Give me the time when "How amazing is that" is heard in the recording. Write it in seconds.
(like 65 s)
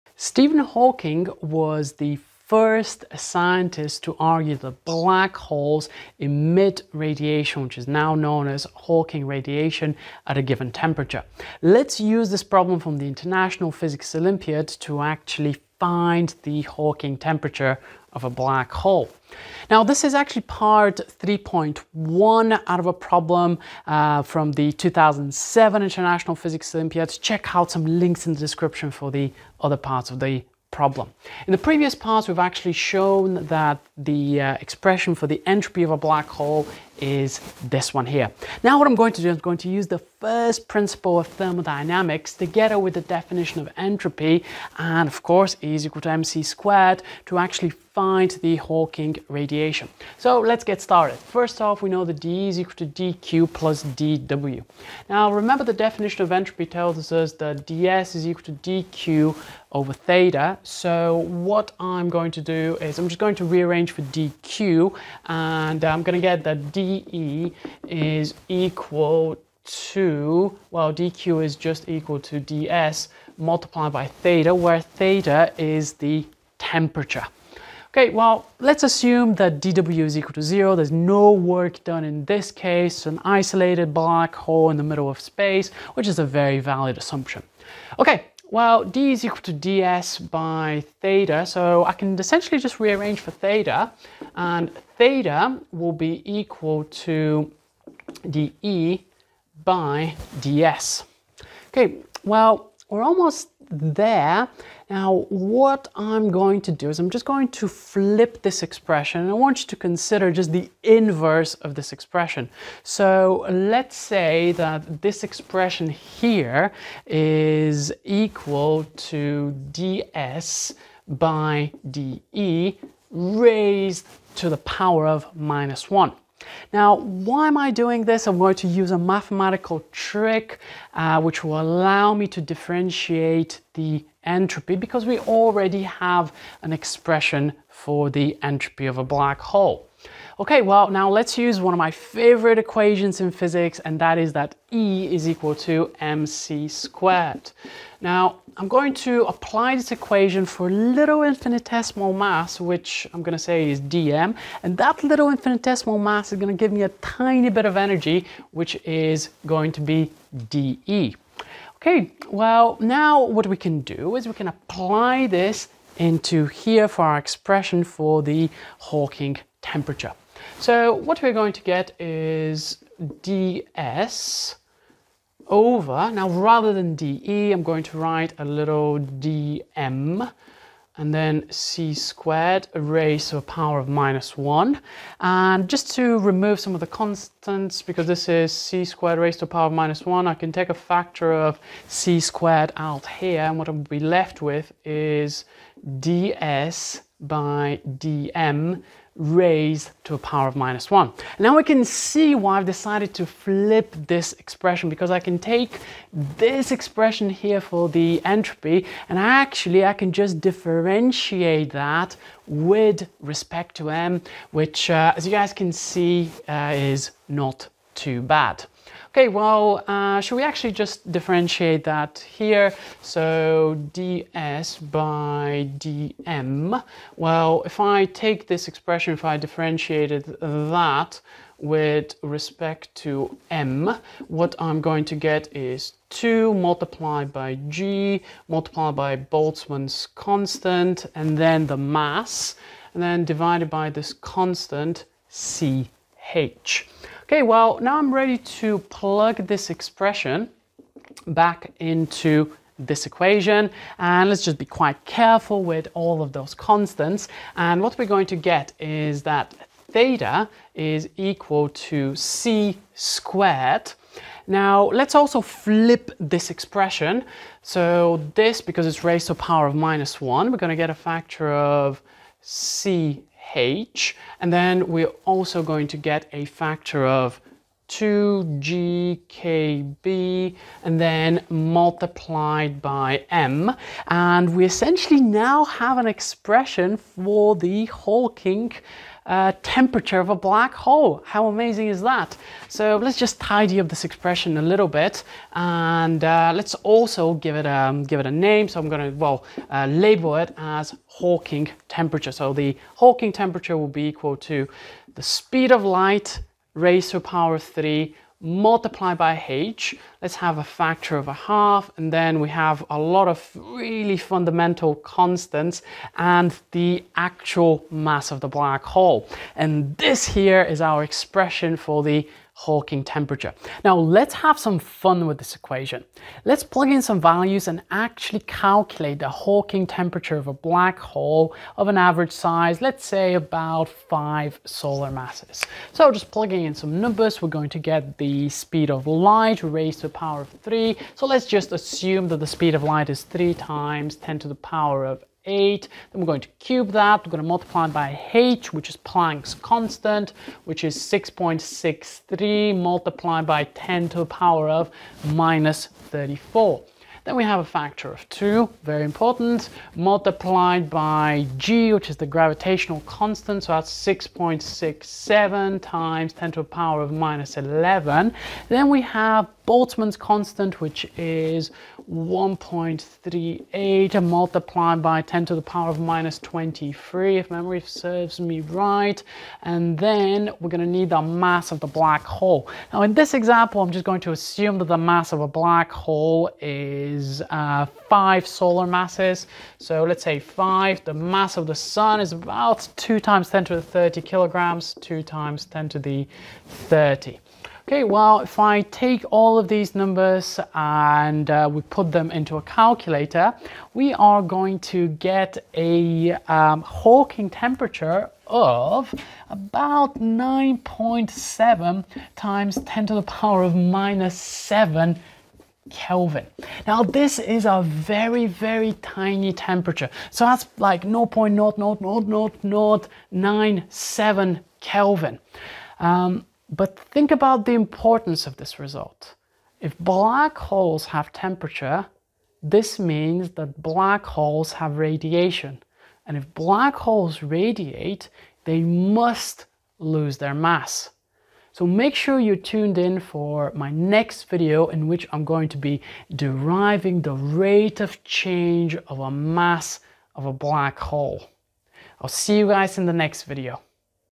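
291 s.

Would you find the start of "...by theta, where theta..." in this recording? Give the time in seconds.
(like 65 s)
73 s.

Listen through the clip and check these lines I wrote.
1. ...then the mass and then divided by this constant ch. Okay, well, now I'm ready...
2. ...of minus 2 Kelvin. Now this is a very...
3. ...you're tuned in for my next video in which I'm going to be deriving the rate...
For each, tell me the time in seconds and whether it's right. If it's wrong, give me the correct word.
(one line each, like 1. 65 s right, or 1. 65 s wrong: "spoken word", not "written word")
1. 241 s right
2. 413 s wrong: "7", not "2"
3. 442 s right.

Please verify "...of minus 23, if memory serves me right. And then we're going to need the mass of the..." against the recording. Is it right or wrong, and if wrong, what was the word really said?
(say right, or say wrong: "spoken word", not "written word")
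right.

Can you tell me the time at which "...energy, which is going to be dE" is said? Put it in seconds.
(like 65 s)
157 s.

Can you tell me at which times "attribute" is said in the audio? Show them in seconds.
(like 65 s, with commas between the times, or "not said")
not said.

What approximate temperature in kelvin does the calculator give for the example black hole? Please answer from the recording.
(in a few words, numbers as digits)
9.7 × 10^-7 K.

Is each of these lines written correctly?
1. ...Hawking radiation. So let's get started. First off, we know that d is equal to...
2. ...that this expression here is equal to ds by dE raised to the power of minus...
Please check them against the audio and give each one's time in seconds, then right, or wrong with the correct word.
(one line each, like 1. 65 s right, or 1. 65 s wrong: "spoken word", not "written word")
1. 48 s right
2. 114 s right.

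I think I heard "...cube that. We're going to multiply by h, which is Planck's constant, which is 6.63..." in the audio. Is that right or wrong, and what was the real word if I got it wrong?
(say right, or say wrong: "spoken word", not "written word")
right.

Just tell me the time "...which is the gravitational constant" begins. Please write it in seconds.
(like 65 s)
361 s.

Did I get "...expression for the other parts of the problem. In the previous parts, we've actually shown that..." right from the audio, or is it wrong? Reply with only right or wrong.
wrong.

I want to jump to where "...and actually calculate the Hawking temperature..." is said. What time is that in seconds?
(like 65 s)
327 s.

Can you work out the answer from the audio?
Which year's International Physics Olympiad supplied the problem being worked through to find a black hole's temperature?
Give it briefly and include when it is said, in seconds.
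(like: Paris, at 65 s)
2007, at 24 s.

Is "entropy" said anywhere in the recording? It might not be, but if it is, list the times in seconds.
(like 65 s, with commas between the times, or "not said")
35 s, 43 s, 56 s, 134 s, 138 s, 208 s.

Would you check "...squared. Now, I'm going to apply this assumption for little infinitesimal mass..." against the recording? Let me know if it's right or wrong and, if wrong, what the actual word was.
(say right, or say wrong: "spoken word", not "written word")
wrong: "equation", not "assumption".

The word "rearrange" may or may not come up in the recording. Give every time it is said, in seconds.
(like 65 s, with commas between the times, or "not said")
63 s, 92 s.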